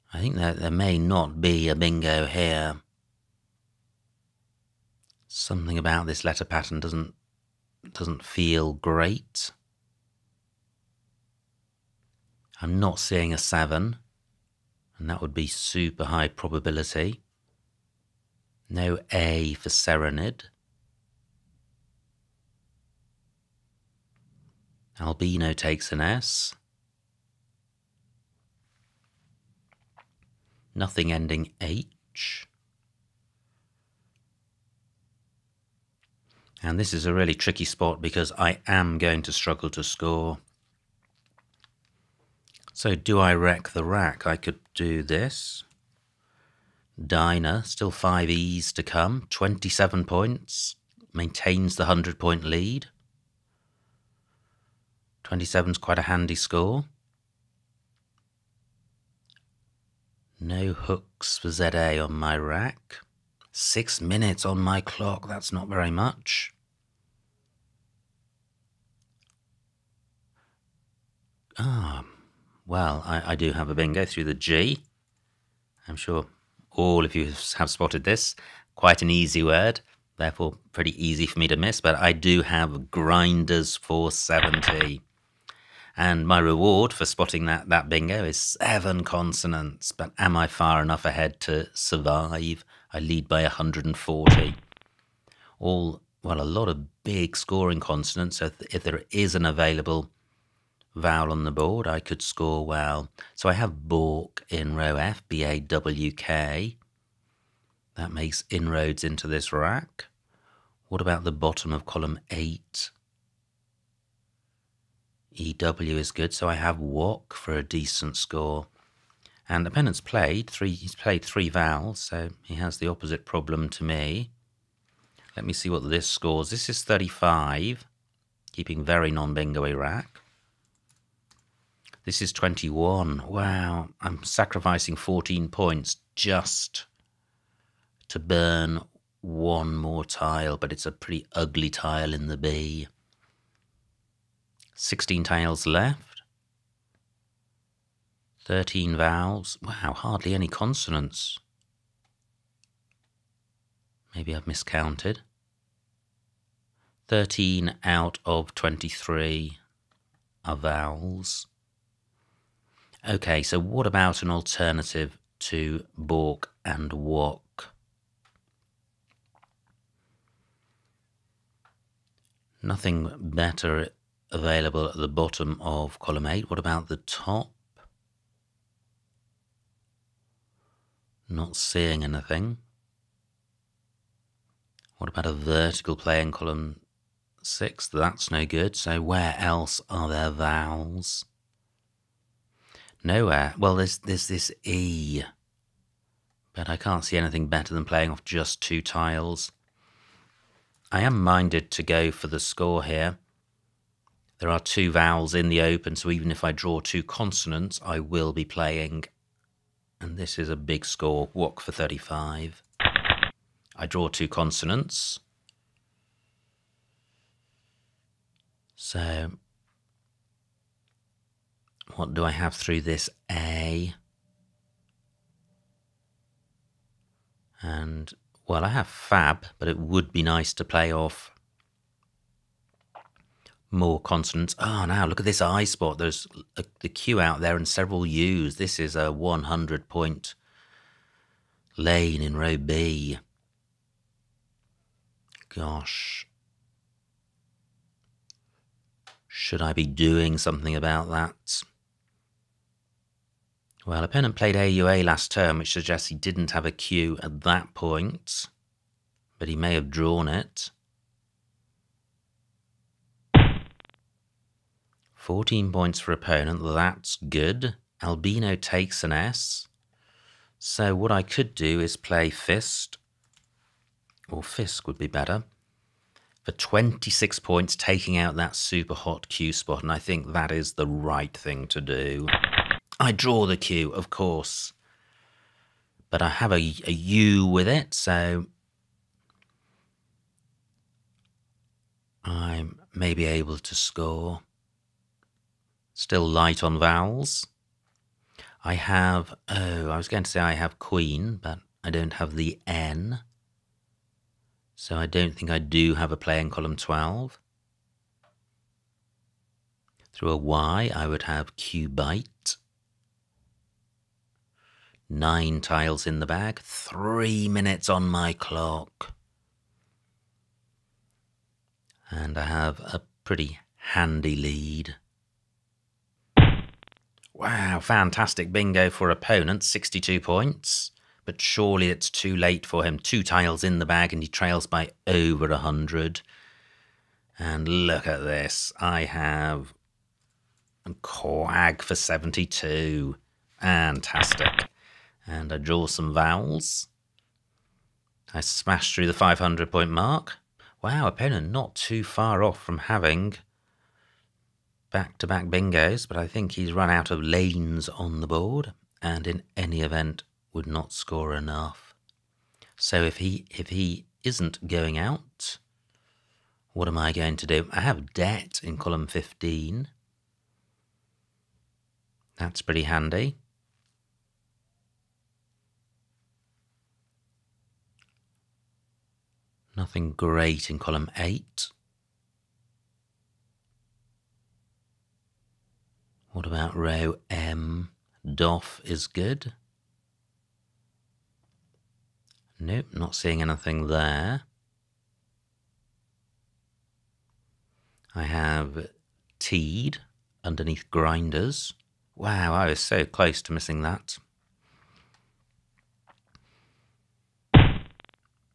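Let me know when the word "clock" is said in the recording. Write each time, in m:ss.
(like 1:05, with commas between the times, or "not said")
1:04, 5:18.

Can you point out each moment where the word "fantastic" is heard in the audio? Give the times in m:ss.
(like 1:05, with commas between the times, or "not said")
5:27, 5:43.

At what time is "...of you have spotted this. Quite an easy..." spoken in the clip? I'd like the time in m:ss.
1:17.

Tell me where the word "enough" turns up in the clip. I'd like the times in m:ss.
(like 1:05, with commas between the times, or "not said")
1:30, 6:01.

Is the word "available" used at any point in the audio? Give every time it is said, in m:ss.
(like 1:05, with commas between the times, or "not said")
1:39, 2:54.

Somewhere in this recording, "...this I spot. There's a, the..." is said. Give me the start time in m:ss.
3:55.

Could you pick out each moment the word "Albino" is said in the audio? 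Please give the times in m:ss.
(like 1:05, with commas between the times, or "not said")
0:25, 4:28.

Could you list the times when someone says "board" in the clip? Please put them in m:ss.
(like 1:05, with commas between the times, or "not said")
1:41, 5:58.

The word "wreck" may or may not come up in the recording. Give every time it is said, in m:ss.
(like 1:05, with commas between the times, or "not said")
0:43.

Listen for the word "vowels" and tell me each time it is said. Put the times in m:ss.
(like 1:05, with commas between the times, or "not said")
1:40, 2:01, 2:28, 2:40, 3:10, 3:24, 4:56, 5:46.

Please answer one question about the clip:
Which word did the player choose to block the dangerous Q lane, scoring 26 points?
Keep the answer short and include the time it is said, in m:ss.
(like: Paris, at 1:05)
Fisk, at 4:34.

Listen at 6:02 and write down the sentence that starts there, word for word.
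So if he if he isn't going out, what am I going to do?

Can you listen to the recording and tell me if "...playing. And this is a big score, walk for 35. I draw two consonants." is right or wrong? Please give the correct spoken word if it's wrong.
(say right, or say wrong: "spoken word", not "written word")
right.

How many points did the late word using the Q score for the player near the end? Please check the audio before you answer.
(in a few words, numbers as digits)
72.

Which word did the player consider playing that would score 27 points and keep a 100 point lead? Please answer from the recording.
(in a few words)
Diner.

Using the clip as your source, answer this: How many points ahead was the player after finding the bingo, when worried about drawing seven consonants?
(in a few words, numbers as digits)
140.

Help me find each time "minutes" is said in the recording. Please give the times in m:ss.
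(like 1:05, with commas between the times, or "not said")
1:04, 5:17.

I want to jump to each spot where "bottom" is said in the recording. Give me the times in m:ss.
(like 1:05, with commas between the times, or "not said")
1:51, 2:55.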